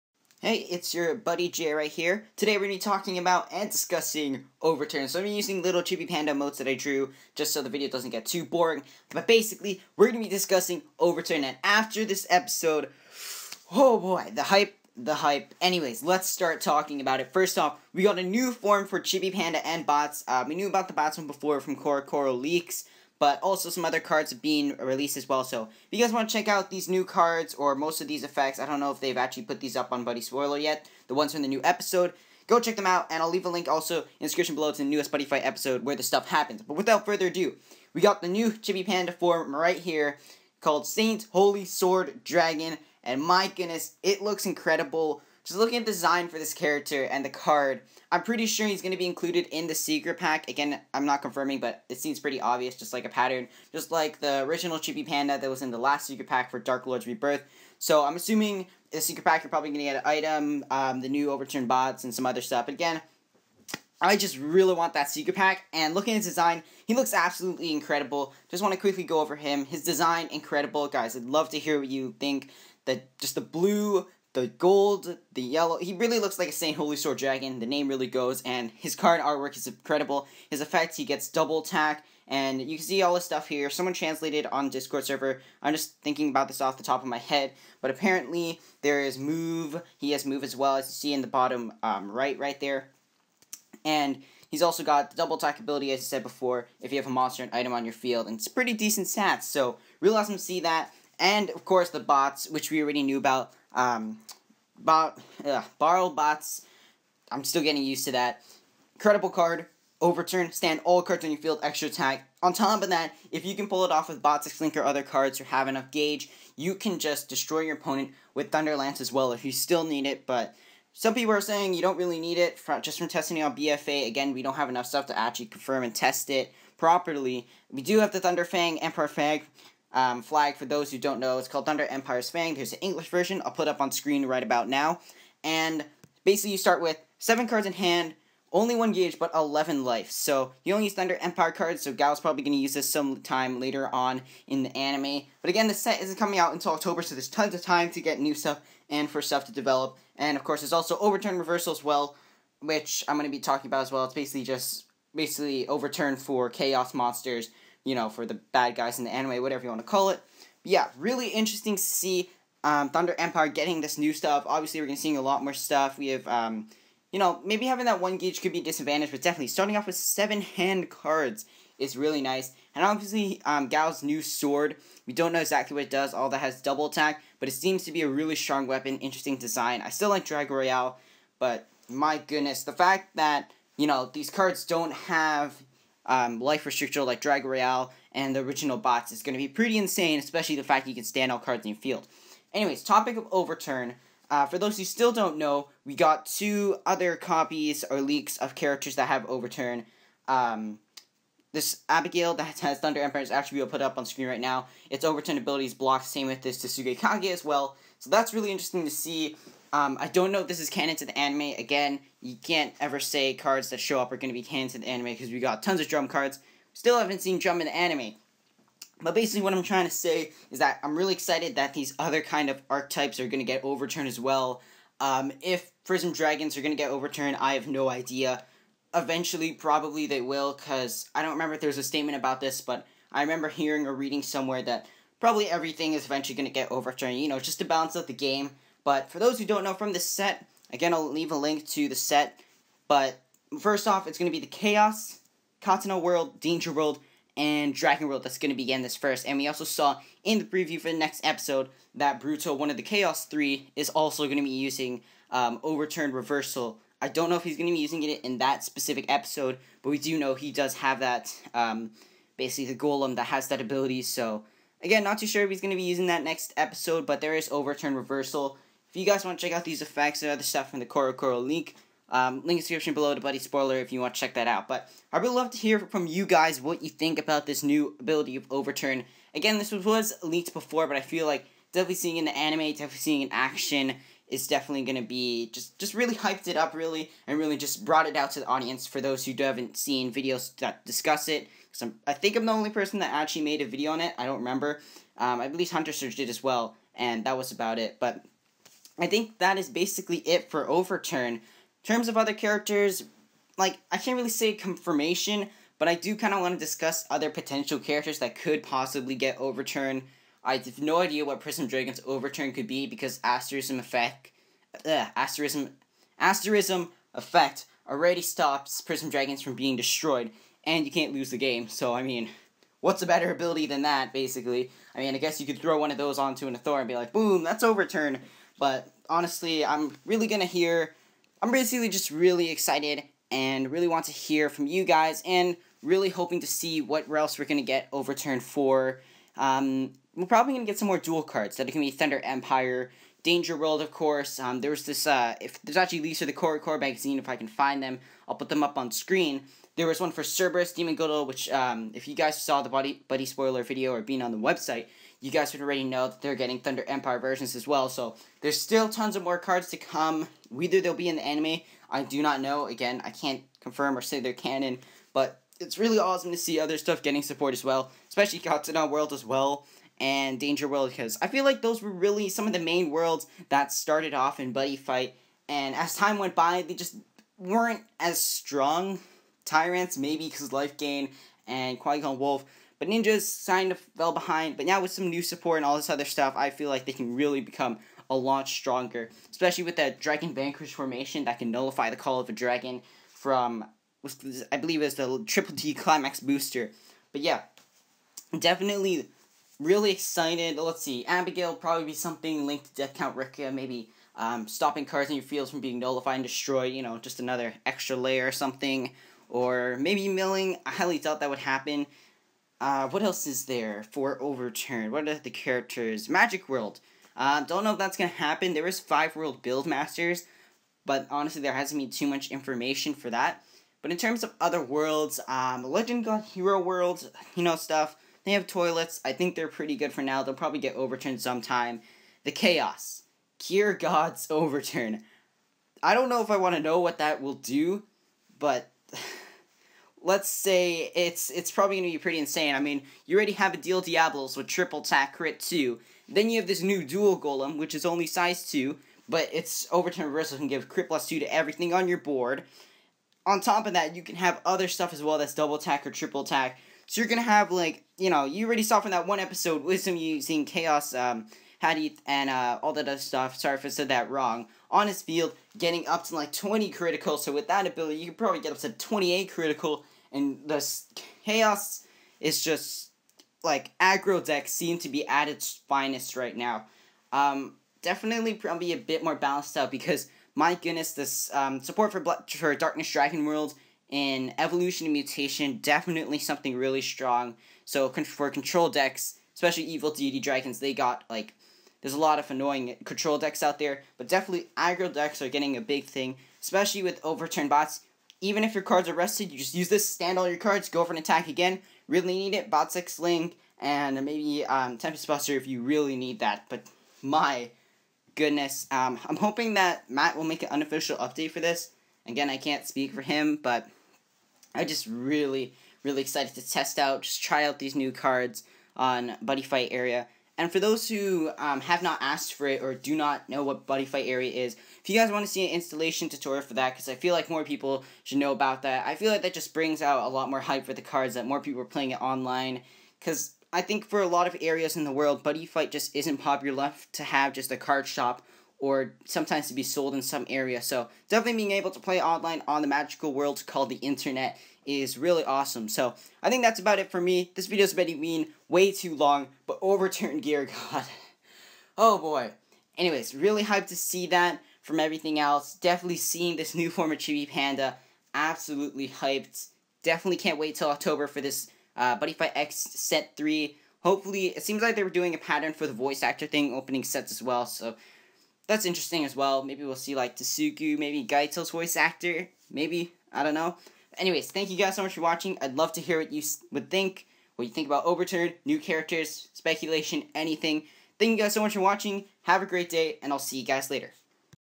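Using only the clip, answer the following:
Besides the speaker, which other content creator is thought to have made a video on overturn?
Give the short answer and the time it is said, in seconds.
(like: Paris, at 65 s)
Hunter Surge, at 295 s.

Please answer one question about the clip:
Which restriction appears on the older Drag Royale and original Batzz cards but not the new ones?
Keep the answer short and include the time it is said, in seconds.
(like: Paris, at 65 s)
Life Restrictor, at 186 s.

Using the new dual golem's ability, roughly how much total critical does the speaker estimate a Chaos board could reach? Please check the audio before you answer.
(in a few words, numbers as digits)
28.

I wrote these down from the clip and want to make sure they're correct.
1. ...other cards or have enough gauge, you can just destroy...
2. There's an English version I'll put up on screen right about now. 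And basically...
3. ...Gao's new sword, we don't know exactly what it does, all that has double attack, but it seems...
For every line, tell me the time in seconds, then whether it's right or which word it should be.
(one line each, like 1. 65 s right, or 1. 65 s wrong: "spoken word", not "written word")
1. 114 s right
2. 132 s right
3. 173 s right.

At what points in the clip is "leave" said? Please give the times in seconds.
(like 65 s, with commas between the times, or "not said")
33 s, 241 s.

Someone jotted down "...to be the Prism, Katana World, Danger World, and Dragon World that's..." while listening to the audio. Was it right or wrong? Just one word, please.
wrong.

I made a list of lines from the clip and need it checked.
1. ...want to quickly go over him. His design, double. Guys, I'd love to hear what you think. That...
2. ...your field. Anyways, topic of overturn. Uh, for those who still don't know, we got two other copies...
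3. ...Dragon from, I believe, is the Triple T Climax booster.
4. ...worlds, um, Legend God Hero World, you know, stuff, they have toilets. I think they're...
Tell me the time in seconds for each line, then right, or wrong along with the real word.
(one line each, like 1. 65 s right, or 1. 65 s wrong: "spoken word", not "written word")
1. 68 s wrong: "incredible", not "double"
2. 191 s right
3. 392 s right
4. 424 s right.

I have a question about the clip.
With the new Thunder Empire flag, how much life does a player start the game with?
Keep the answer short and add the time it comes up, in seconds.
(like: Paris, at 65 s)
11, at 139 s.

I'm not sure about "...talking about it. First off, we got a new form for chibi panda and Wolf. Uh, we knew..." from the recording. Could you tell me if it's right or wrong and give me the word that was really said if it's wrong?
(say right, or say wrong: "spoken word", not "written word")
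wrong: "Batzz", not "Wolf".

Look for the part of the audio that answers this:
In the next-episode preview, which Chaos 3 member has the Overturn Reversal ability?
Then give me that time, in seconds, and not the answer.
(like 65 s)
252 s.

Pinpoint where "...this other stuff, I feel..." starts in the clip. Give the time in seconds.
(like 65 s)
385 s.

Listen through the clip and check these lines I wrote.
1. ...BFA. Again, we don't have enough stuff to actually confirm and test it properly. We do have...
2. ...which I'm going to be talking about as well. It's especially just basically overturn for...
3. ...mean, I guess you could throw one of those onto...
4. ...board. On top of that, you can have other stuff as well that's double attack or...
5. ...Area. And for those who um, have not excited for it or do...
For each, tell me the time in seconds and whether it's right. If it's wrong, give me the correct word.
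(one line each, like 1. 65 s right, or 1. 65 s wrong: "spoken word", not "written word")
1. 123 s right
2. 152 s wrong: "basically", not "especially"
3. 324 s right
4. 451 s right
5. 519 s wrong: "asked", not "excited".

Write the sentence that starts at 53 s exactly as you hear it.
Just like the original Chibi Panda that was in the last secret pack for Dark Lord's Rebirth.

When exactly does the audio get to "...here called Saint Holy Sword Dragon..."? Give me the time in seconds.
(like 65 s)
39 s.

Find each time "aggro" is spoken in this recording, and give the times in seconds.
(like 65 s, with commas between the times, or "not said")
473 s, 494 s.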